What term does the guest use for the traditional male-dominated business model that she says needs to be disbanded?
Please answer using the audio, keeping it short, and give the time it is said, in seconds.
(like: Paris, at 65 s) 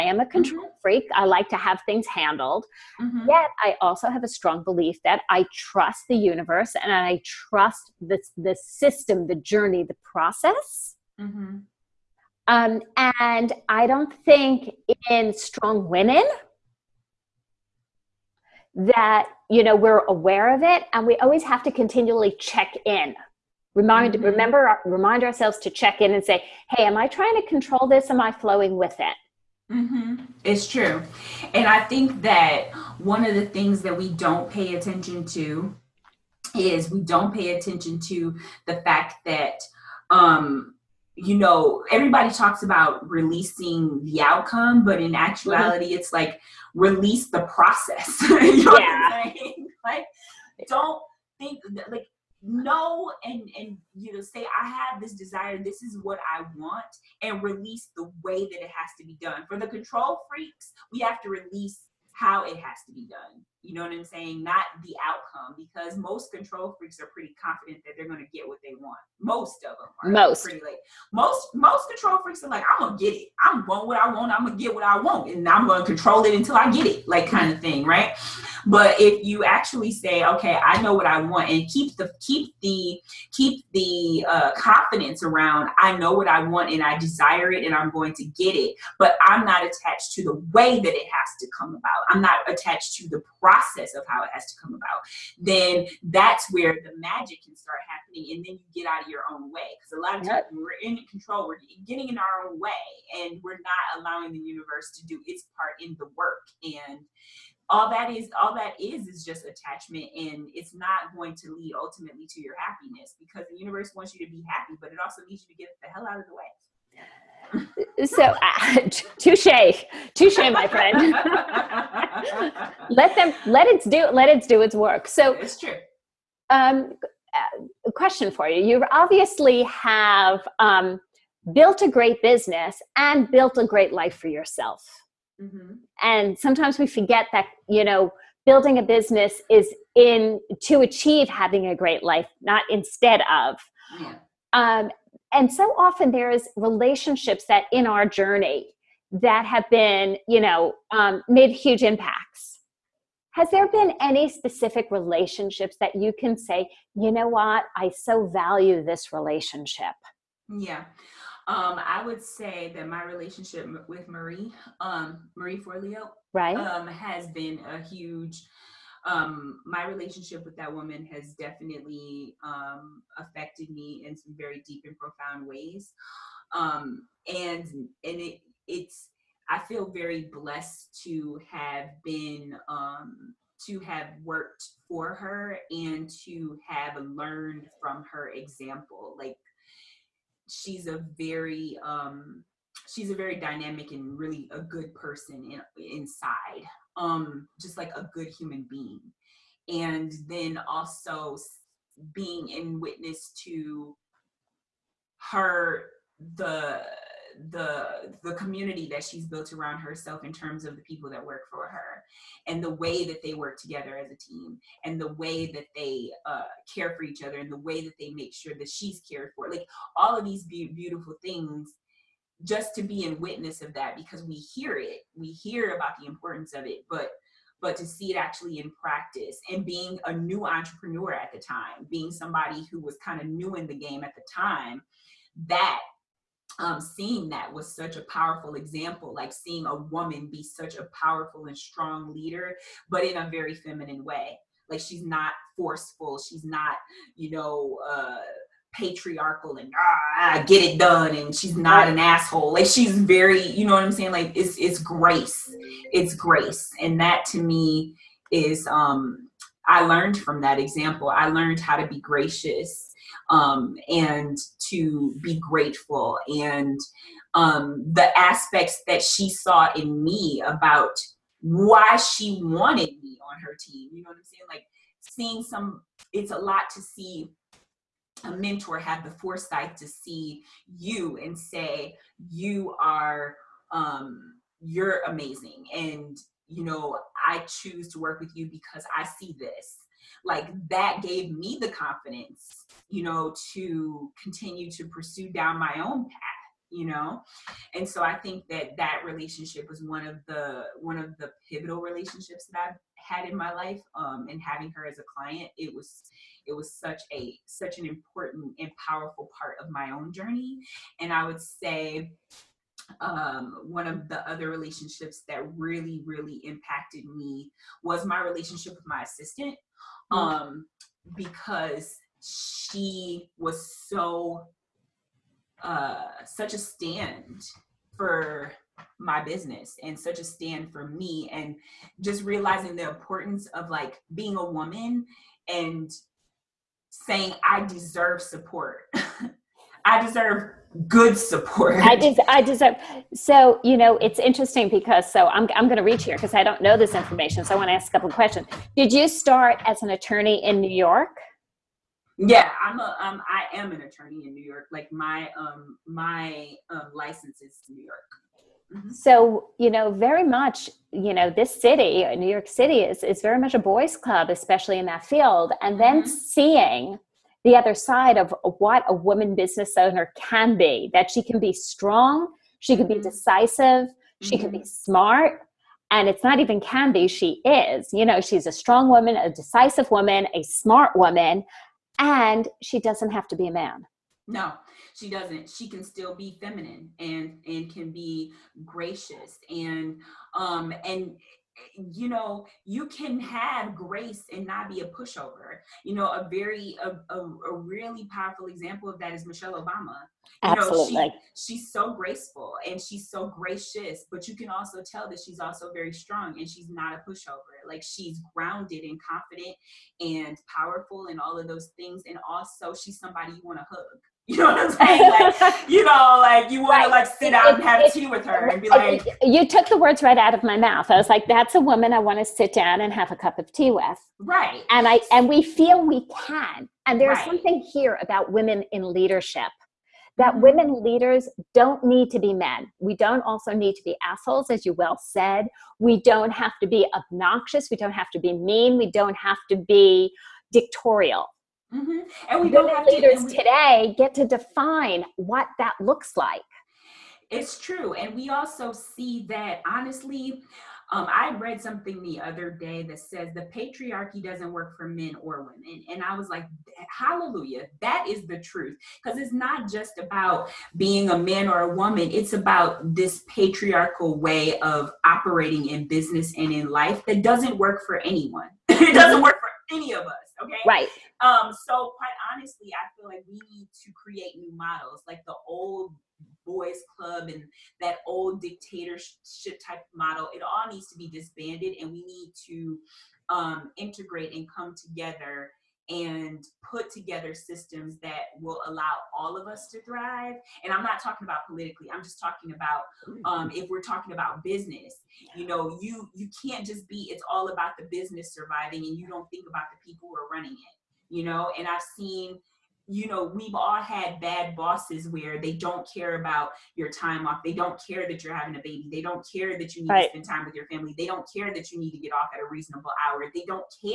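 Old boys club, at 475 s.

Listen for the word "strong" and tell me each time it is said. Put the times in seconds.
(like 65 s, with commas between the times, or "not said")
4 s, 15 s, 241 s, 371 s, 378 s, 405 s.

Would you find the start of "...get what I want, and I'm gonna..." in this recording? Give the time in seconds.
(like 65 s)
74 s.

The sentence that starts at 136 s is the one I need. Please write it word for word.
and sometimes we forget that you know building a business is in to achieve having a great life not instead of yeah.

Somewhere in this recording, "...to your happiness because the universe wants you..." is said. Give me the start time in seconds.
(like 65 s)
112 s.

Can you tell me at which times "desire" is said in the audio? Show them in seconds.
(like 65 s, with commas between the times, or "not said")
55 s, 86 s.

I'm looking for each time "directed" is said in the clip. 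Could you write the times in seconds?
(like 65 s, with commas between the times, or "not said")
not said.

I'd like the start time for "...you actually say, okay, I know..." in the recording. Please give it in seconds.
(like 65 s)
79 s.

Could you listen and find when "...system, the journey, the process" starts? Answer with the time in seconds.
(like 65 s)
8 s.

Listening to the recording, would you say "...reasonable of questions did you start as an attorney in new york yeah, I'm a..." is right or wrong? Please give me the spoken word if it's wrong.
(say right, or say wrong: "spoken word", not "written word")
wrong: "couple", not "reasonable".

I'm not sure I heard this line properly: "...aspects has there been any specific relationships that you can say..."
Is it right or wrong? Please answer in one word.
wrong.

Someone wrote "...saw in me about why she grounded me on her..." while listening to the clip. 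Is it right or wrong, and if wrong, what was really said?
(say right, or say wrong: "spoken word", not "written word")
wrong: "wanted", not "grounded".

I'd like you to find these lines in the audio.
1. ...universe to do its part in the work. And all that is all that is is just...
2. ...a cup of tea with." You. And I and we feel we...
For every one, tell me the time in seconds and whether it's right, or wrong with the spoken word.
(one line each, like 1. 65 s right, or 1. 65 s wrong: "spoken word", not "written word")
1. 104 s right
2. 423 s wrong: "Right", not "You".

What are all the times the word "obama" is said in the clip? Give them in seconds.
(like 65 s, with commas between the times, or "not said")
399 s.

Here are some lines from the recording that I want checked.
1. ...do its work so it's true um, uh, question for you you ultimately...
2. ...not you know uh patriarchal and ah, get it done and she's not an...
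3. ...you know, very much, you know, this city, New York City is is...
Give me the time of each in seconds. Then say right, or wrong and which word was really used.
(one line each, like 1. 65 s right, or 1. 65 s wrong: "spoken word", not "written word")
1. 124 s wrong: "obviously", not "ultimately"
2. 246 s right
3. 359 s right.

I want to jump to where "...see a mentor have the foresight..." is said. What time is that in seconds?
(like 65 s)
276 s.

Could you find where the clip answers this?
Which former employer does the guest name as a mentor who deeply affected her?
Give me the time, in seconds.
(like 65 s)
165 s.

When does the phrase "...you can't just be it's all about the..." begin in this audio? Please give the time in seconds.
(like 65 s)
496 s.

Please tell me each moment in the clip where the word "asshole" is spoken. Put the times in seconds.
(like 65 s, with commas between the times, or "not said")
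251 s, 434 s.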